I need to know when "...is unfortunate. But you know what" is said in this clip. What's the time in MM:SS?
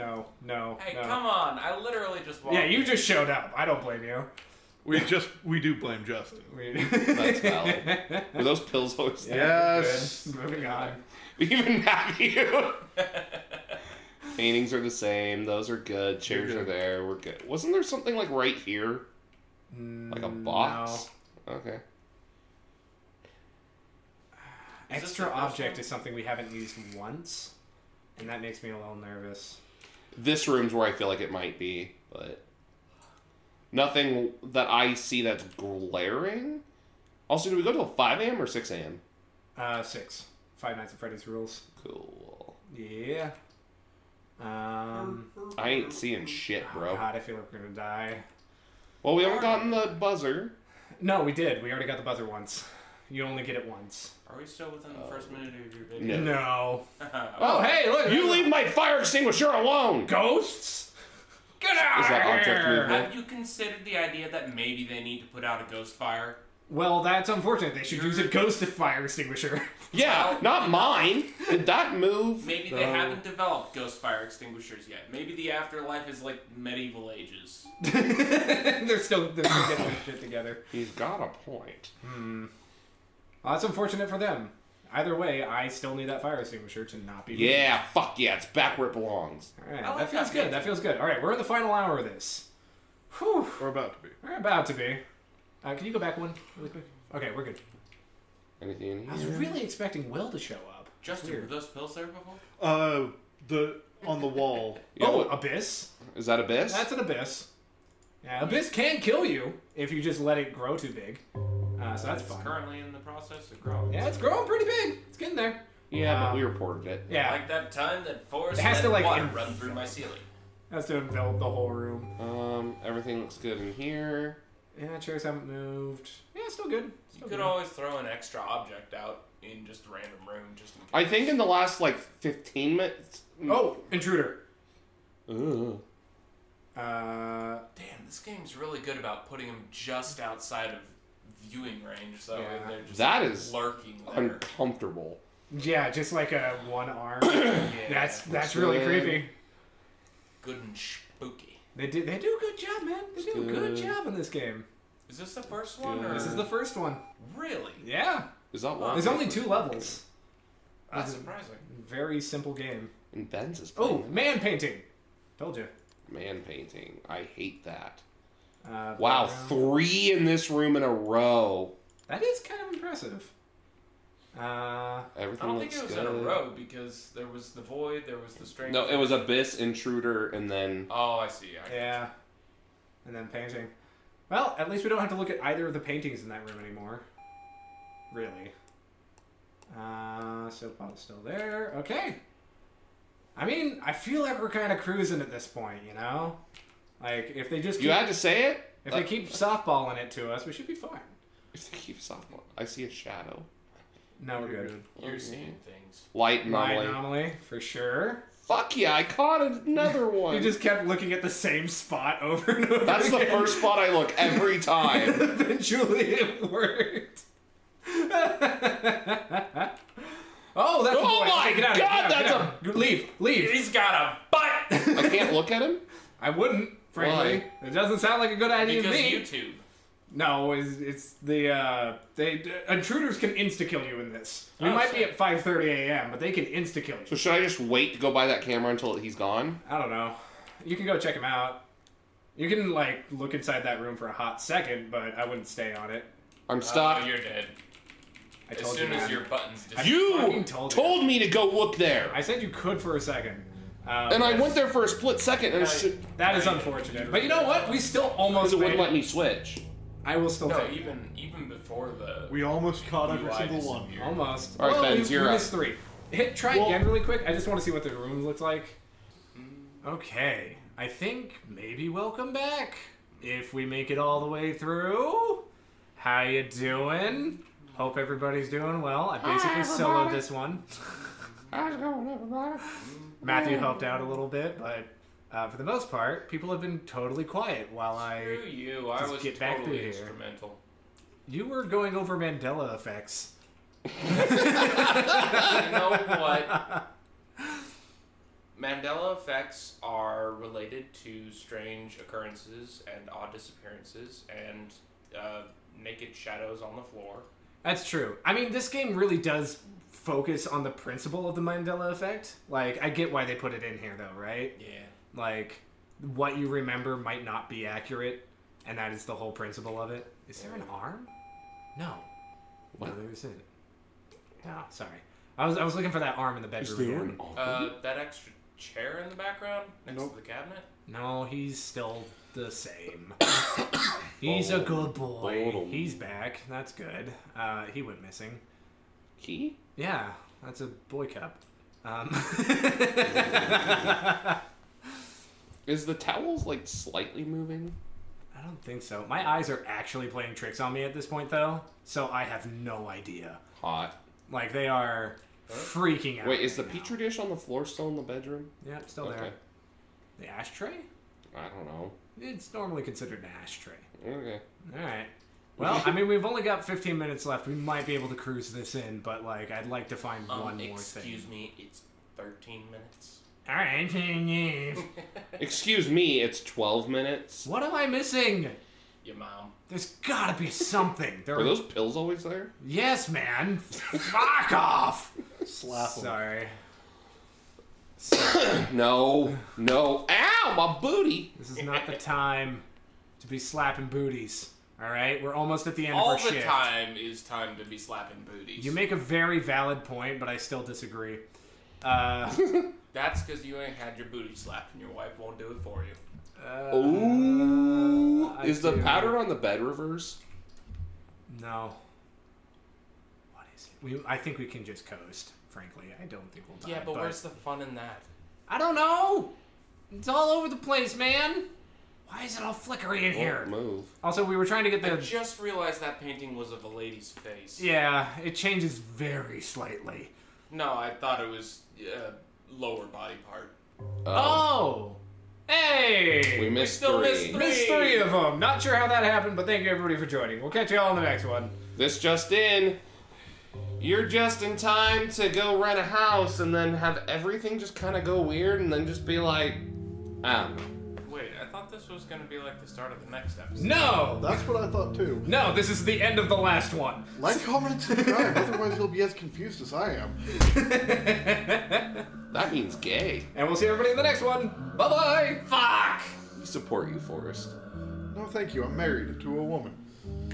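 04:16.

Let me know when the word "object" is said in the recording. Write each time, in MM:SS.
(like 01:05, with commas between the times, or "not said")
00:25, 01:02, 02:08.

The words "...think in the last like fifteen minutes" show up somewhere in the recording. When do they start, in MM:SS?
02:11.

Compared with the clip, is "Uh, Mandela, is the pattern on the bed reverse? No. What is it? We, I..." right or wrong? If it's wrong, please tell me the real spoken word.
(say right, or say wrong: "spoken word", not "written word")
wrong: "Ooh", not "Mandela".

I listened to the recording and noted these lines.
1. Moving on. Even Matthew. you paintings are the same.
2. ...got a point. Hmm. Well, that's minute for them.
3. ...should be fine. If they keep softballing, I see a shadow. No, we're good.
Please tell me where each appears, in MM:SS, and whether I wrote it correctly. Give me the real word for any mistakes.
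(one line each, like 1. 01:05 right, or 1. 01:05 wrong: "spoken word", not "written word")
1. 00:10 right
2. 01:20 wrong: "unfortunate", not "minute"
3. 03:20 right.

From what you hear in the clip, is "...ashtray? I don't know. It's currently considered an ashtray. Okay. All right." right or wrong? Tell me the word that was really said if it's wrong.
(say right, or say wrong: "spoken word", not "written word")
wrong: "normally", not "currently".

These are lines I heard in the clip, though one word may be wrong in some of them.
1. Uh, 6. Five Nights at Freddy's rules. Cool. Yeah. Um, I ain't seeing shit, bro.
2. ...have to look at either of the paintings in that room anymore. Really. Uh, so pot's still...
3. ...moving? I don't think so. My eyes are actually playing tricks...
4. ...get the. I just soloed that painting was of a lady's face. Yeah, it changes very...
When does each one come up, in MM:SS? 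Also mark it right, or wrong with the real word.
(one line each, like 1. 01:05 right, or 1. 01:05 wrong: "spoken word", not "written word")
1. 00:39 right
2. 03:04 right
3. 05:47 right
4. 07:04 wrong: "realized", not "soloed".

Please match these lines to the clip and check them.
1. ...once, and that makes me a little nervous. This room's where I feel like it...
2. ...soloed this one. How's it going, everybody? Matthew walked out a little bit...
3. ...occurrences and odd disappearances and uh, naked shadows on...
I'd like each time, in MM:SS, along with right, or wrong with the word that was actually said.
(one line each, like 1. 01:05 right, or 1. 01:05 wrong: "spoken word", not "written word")
1. 00:26 right
2. 04:39 wrong: "helped", not "walked"
3. 05:01 right.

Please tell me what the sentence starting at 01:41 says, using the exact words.
Justin, were those pills there before?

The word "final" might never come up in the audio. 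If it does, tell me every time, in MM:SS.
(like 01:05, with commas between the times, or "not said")
01:31.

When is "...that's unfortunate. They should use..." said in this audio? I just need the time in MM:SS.
01:07.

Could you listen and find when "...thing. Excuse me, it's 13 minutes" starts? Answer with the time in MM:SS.
06:10.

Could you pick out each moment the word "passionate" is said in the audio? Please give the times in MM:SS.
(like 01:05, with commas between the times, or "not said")
not said.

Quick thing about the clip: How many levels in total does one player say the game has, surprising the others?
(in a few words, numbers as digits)
Two.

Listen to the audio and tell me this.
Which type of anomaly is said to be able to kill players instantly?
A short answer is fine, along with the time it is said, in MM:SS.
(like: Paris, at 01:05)
Intruders, at 03:52.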